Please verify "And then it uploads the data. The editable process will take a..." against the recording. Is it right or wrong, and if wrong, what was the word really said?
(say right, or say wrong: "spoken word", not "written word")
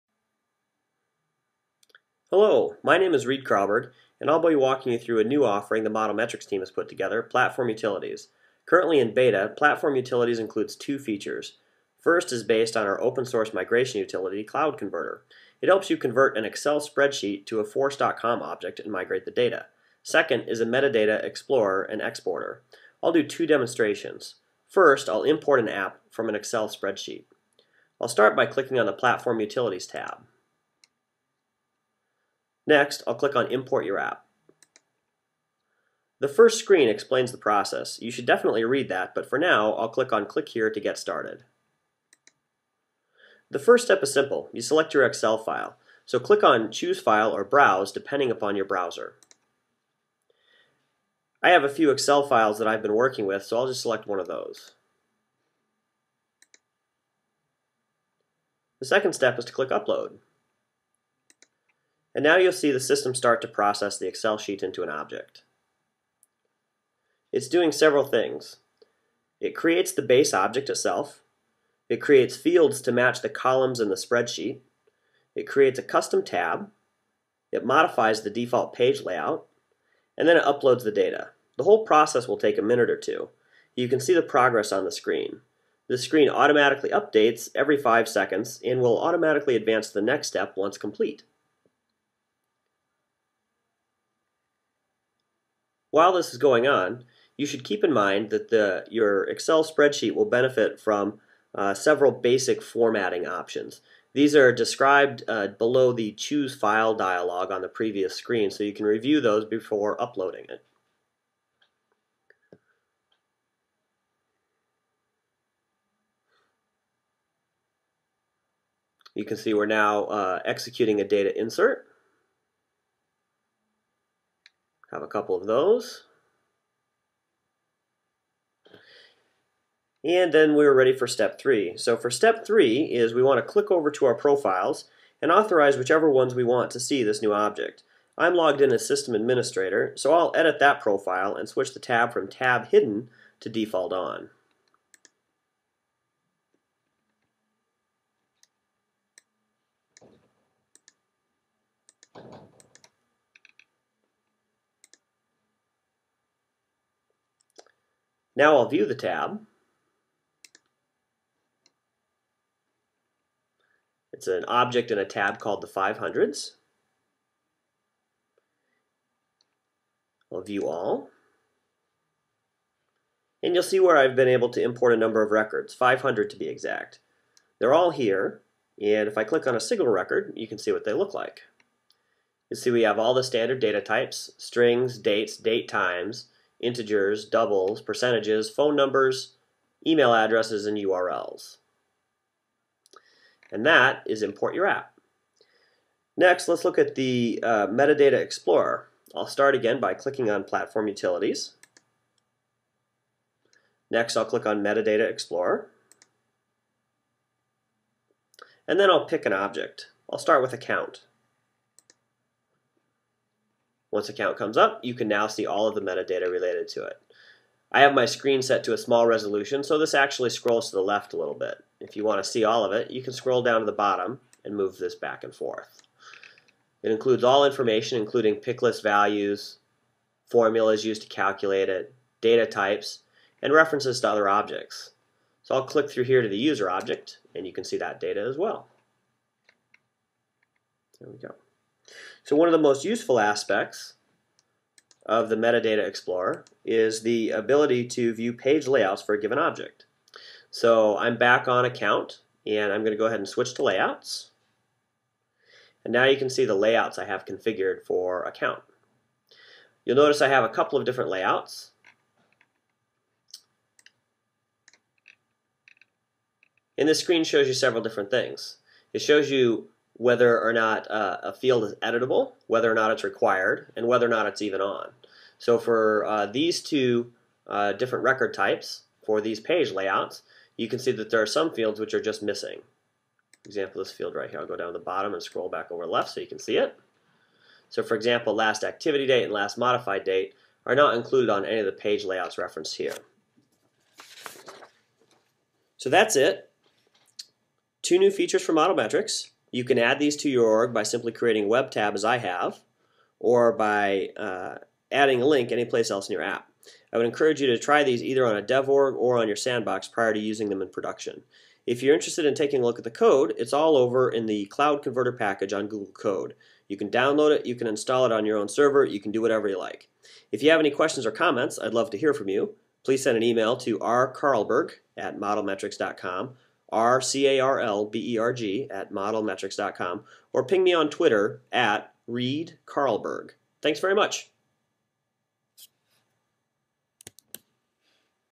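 wrong: "whole", not "editable".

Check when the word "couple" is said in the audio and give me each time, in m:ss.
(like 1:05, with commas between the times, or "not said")
2:05, 4:20.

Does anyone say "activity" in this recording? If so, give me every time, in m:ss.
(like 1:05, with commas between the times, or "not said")
4:48.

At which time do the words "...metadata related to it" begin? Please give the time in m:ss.
3:35.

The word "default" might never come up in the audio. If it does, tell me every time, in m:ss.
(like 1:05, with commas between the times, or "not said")
1:18, 2:23.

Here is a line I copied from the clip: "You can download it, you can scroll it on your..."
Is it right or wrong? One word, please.
wrong.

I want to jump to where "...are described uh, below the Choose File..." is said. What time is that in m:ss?
1:44.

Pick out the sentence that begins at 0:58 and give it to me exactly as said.
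The second step is to click Upload.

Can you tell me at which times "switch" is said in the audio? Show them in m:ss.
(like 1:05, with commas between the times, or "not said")
2:21, 4:13.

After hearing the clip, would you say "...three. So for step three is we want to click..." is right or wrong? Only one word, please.
right.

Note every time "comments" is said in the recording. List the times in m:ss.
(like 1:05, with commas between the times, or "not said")
5:21.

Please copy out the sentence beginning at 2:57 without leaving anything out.
They're all here, and if I click on a single record, you can see what they look like.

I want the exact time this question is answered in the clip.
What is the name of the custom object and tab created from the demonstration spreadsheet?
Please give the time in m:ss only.
2:45.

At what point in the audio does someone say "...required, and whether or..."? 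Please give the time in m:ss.
4:33.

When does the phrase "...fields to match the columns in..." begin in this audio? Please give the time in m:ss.
1:12.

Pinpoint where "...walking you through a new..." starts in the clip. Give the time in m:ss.
0:04.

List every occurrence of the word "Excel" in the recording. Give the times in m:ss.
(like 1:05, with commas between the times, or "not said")
0:16, 0:26, 0:45, 0:51, 1:04, 1:39.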